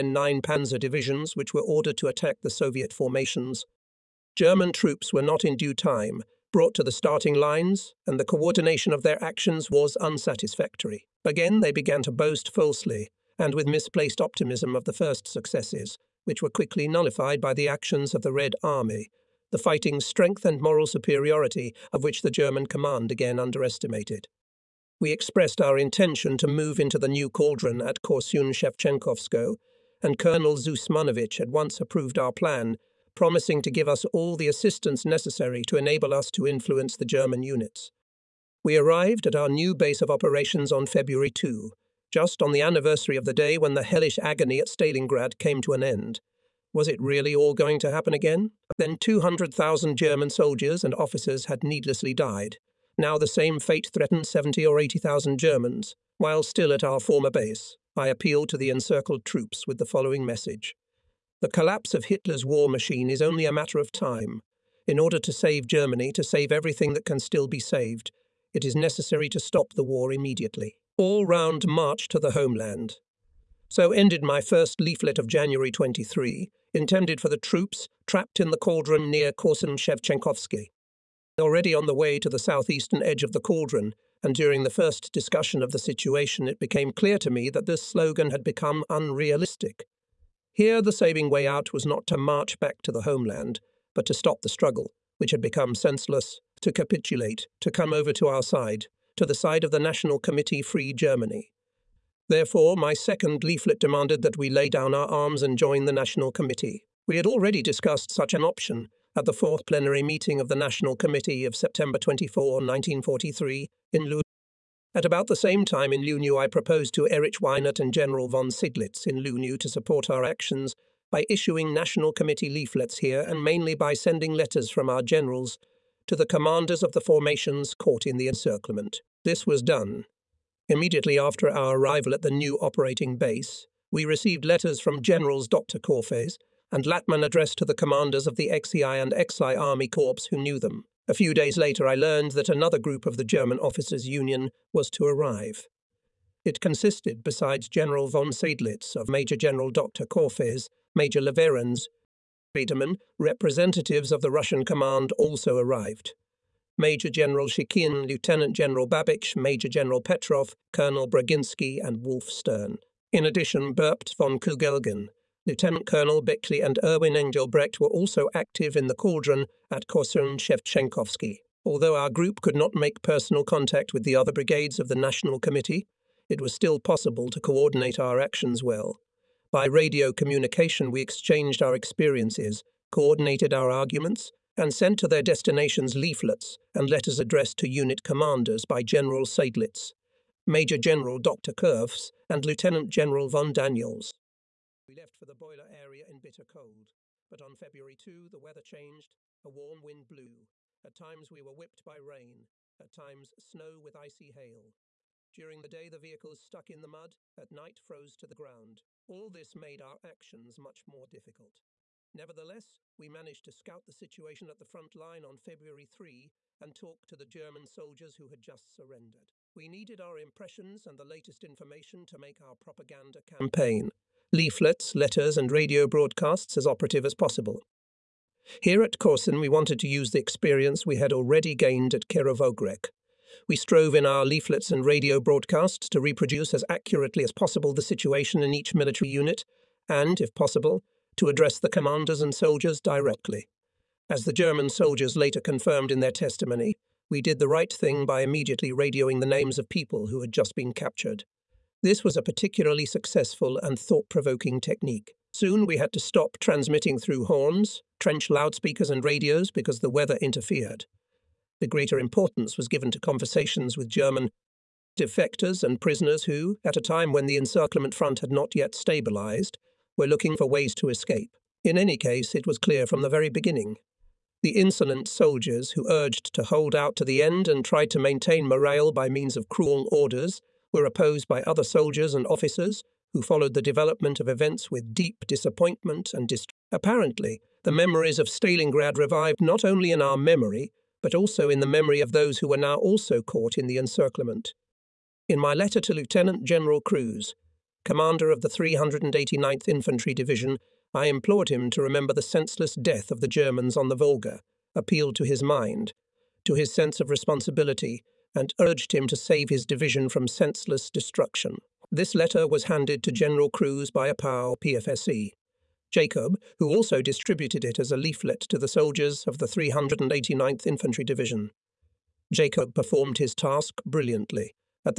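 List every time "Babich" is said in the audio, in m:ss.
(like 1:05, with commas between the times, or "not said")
2:38.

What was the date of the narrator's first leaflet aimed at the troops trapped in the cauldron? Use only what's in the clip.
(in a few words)
January 23.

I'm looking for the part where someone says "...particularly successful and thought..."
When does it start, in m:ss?
4:12.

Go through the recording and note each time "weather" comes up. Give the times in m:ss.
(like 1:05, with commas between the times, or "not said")
3:18, 4:19.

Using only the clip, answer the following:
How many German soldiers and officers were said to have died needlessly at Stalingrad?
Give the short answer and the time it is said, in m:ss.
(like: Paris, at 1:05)
200,000, at 0:48.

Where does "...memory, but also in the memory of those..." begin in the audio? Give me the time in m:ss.
4:50.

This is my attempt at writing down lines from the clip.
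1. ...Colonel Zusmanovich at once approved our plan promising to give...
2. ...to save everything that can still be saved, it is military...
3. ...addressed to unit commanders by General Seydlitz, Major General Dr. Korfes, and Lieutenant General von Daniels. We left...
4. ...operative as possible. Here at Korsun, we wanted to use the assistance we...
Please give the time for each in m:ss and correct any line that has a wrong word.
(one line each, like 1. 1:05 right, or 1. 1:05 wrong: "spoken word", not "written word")
1. 0:30 right
2. 1:06 wrong: "necessary", not "military"
3. 3:07 right
4. 3:46 wrong: "experience", not "assistance".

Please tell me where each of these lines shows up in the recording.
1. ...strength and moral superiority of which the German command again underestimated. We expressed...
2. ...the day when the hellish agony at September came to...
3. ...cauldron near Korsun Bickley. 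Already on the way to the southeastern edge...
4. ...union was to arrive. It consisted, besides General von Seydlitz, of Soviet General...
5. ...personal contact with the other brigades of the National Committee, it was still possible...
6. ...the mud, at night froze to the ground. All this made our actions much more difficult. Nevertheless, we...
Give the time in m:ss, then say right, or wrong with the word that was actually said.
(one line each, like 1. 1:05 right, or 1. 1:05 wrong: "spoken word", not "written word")
1. 0:19 right
2. 0:43 wrong: "Stalingrad", not "September"
3. 1:18 wrong: "Shevchenkovsky", not "Bickley"
4. 2:24 wrong: "Major", not "Soviet"
5. 2:52 right
6. 3:26 right.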